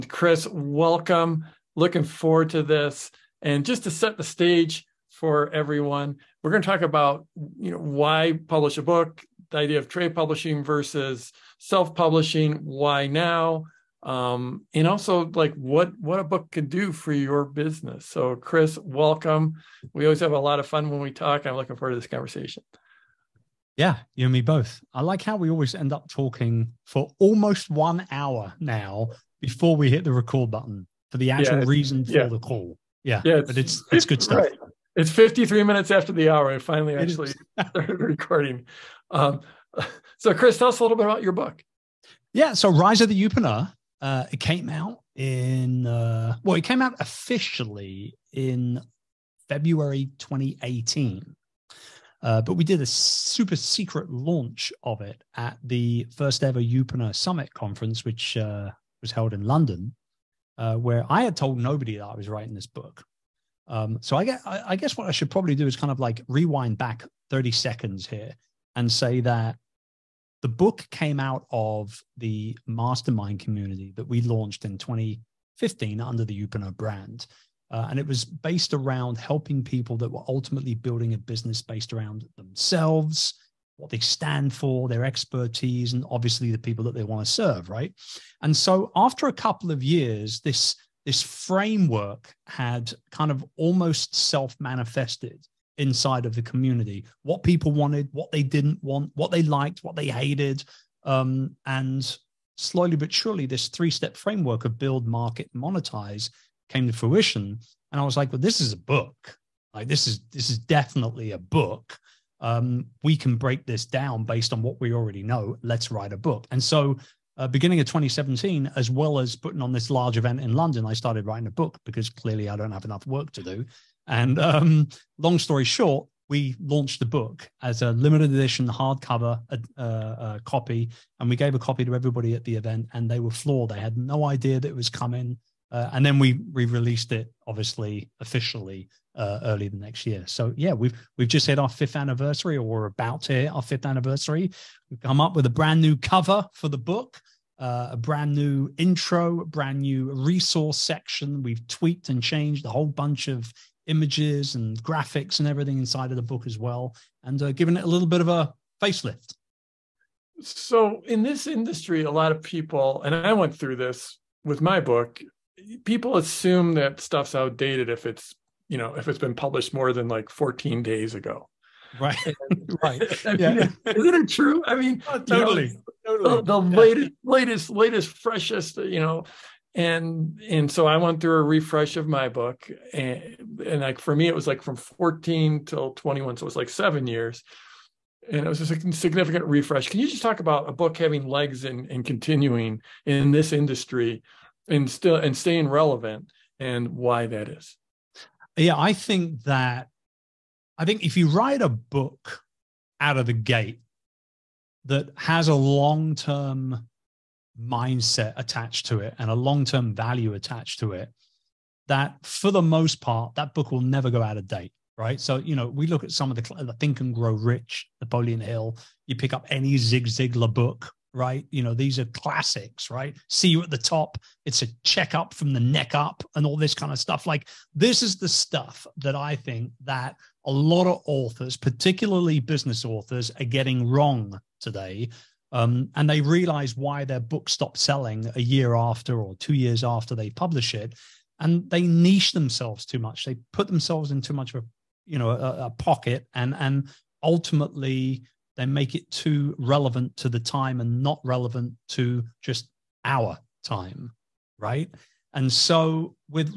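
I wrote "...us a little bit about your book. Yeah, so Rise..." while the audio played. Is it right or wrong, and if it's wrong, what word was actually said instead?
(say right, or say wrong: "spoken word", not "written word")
right.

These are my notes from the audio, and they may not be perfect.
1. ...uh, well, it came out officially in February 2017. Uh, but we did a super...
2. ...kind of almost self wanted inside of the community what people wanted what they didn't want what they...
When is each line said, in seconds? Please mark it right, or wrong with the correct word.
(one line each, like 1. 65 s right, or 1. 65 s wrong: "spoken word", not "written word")
1. 45 s wrong: "2018", not "2017"
2. 93 s wrong: "manifested", not "wanted".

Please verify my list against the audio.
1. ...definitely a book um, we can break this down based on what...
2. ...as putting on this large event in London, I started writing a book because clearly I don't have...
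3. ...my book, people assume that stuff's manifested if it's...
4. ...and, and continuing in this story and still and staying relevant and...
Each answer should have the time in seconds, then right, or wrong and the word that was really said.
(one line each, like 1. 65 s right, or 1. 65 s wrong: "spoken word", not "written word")
1. 110 s right
2. 119 s right
3. 164 s wrong: "outdated", not "manifested"
4. 191 s wrong: "industry", not "story".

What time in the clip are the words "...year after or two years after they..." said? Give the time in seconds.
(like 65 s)
238 s.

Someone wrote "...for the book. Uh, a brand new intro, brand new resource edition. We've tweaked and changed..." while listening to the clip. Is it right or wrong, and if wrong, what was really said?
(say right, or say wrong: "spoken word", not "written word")
wrong: "section", not "edition".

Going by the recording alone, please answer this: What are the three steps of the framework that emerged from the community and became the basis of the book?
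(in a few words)
Build, market, monetize.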